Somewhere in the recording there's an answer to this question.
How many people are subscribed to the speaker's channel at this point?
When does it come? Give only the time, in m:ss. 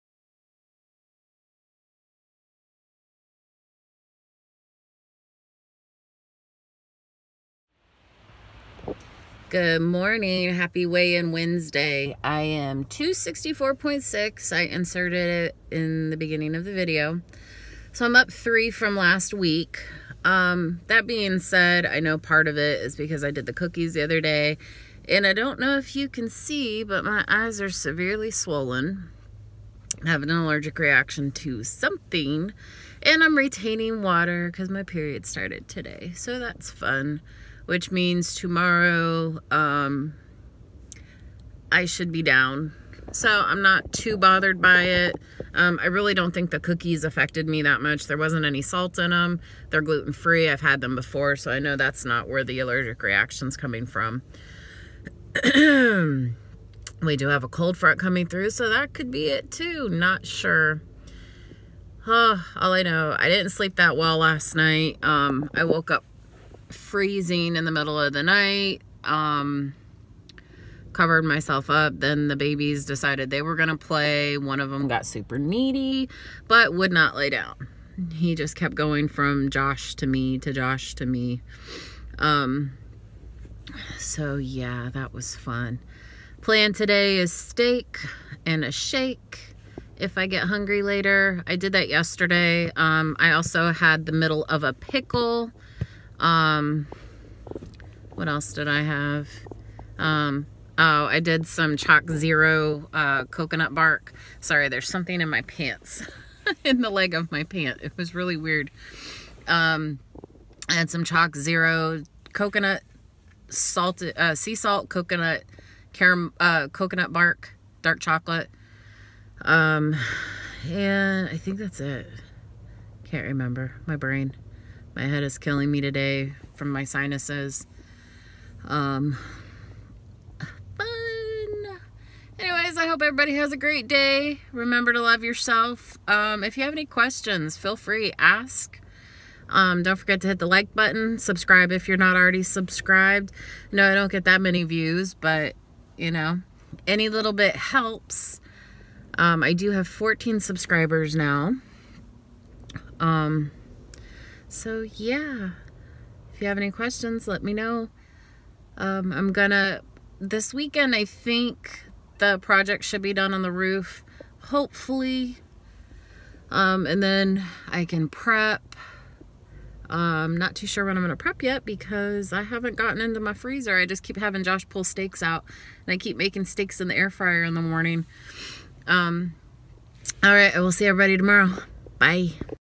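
2:29.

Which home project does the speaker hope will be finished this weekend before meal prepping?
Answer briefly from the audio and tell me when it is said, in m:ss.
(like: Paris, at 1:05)
The roof, at 2:43.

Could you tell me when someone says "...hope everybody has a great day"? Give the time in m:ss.
2:12.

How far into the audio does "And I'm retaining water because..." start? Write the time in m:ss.
0:33.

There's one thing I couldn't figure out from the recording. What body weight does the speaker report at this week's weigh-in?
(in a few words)
264.6.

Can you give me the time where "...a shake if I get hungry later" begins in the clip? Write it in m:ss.
1:28.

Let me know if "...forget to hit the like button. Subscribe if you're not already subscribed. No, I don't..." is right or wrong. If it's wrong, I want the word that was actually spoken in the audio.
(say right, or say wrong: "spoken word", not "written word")
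right.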